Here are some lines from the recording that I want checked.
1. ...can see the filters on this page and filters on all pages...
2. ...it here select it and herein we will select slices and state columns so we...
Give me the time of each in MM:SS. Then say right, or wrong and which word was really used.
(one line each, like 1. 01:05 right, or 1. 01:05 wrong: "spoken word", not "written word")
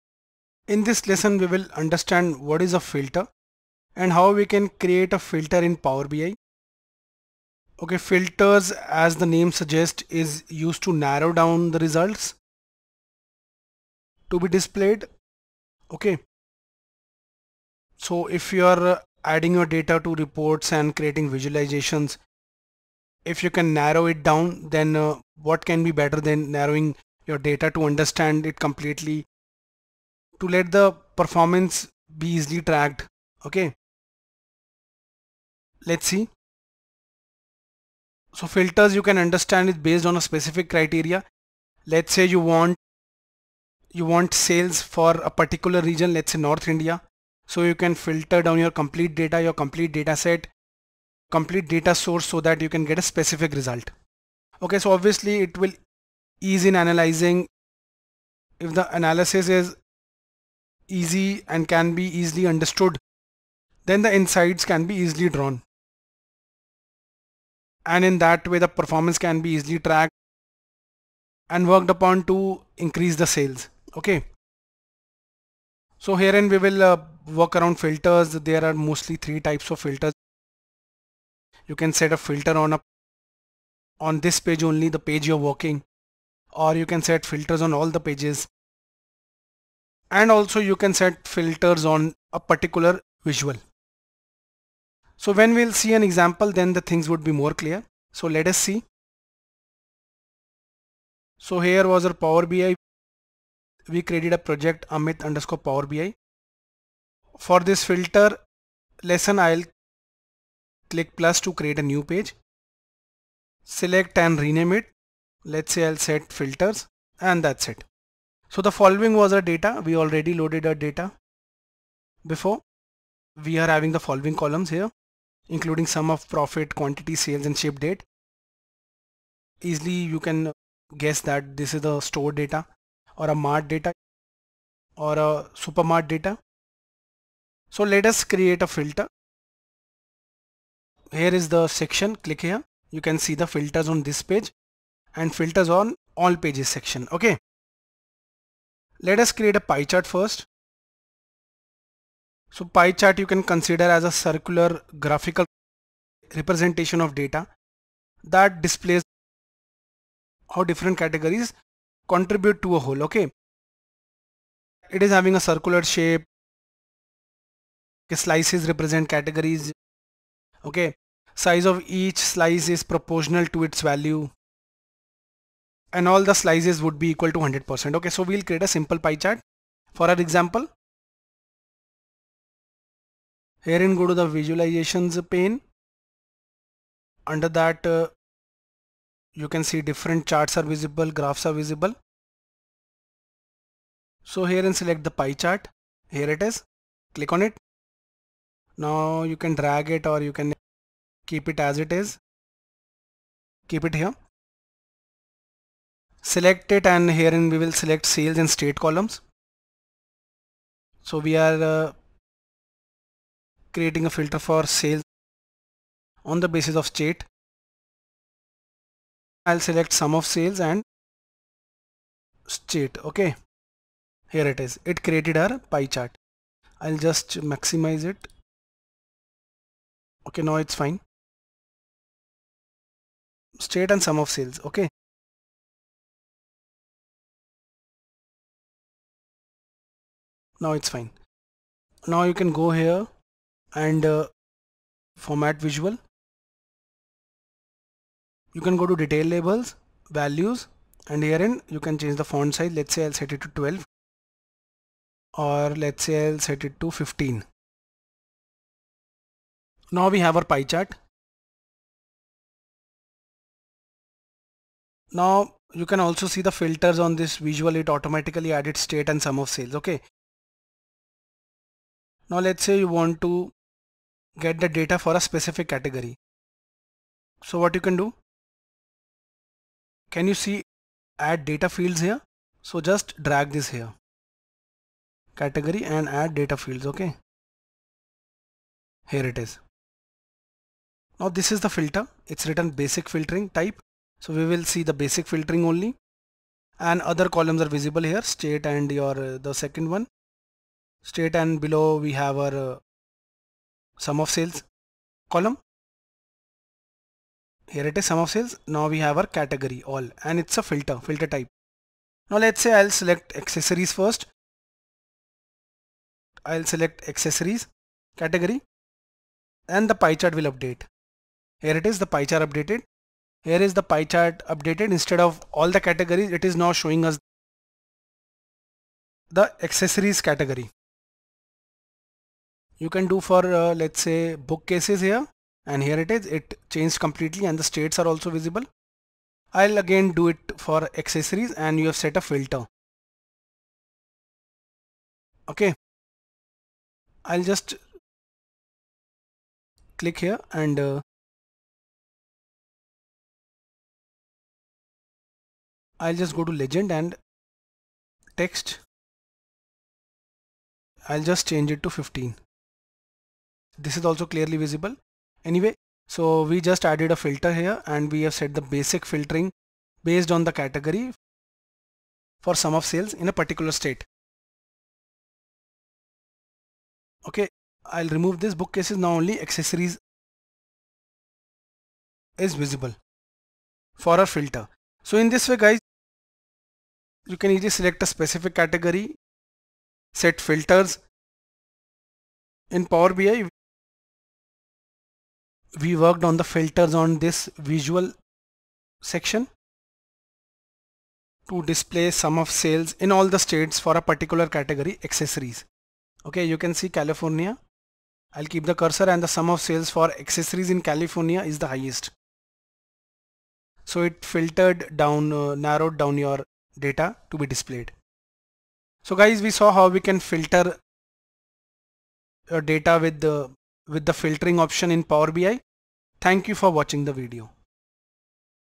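1. 02:22 right
2. 03:23 wrong: "sales", not "slices".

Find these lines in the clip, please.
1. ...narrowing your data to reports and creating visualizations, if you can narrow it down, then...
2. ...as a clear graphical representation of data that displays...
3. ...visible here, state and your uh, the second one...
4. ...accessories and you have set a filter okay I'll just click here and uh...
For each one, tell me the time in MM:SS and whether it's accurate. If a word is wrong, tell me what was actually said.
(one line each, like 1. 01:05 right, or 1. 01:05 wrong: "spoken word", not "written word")
1. 00:19 wrong: "adding", not "narrowing"
2. 02:33 wrong: "circular", not "clear"
3. 04:57 right
4. 05:41 right.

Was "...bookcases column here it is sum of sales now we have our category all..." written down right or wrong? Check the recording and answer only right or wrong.
wrong.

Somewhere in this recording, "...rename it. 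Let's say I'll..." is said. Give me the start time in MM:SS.
01:54.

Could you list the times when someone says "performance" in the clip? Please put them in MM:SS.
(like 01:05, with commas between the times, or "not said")
00:31, 01:08.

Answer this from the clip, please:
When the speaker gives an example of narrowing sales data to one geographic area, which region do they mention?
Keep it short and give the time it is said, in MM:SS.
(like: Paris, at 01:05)
North India, at 00:46.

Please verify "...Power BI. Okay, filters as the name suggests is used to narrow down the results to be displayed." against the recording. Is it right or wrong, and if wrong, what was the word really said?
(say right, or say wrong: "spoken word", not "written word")
right.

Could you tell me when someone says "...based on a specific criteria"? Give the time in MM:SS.
00:39.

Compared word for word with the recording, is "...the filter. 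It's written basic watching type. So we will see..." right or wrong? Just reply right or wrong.
wrong.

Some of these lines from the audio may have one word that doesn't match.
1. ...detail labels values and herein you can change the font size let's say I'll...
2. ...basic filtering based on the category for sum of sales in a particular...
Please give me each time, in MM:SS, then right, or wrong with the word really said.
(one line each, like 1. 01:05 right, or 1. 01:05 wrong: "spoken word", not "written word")
1. 04:09 right
2. 06:08 right.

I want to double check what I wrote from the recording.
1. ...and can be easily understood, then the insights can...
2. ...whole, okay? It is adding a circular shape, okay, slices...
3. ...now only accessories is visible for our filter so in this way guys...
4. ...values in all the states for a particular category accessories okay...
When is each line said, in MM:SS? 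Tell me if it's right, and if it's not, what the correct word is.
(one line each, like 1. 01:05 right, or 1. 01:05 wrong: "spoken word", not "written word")
1. 01:01 right
2. 02:42 wrong: "having", not "adding"
3. 06:18 right
4. 06:42 wrong: "sales", not "values".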